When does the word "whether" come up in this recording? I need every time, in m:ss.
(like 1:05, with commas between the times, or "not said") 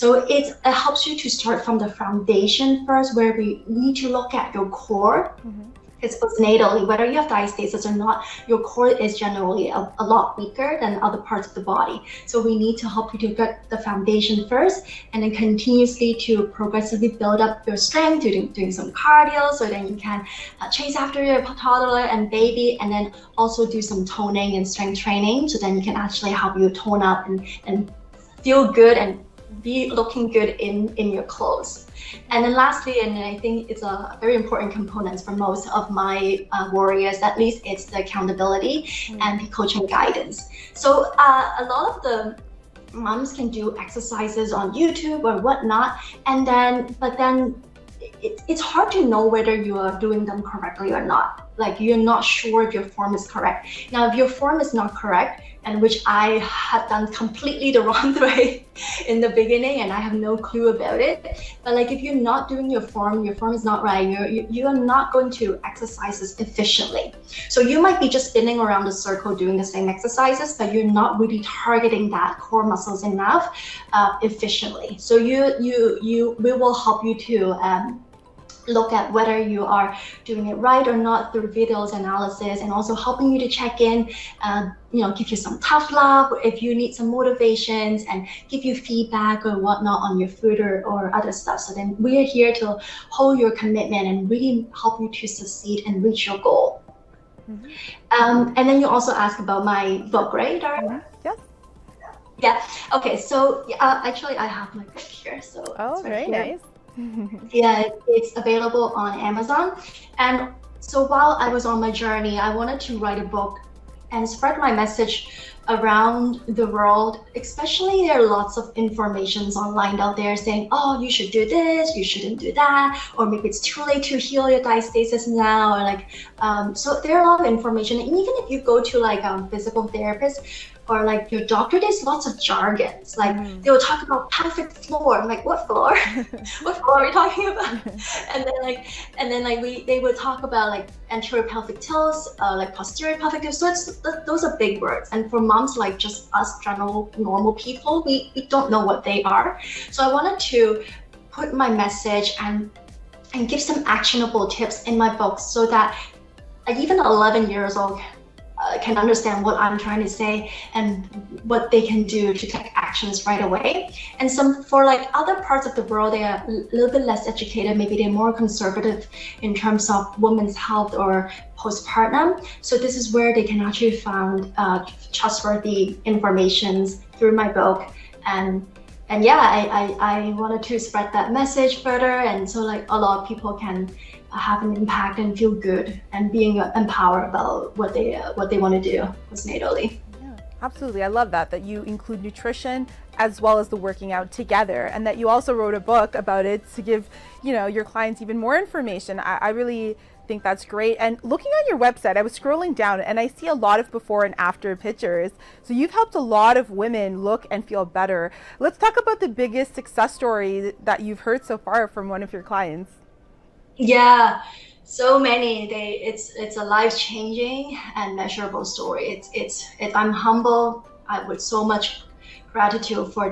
0:06, 0:49, 1:19.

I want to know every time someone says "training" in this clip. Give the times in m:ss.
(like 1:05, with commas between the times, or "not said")
0:24.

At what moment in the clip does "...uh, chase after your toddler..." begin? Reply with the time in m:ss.
0:20.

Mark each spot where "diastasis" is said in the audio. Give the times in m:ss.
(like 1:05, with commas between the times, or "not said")
0:07, 2:04.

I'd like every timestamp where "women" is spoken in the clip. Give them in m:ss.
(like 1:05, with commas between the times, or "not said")
2:50, 3:26.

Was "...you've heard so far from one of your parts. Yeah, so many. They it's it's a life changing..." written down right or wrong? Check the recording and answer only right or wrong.
wrong.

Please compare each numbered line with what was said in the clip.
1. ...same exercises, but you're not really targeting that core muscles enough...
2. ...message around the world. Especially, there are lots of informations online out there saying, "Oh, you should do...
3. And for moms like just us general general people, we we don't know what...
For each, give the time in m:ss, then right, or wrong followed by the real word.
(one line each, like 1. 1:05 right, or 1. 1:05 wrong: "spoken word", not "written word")
1. 1:09 right
2. 1:54 right
3. 2:25 wrong: "normal", not "general".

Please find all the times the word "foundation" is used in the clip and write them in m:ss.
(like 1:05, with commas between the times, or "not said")
0:01, 0:13.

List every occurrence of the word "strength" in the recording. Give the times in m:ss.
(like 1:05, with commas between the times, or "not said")
0:17, 0:24.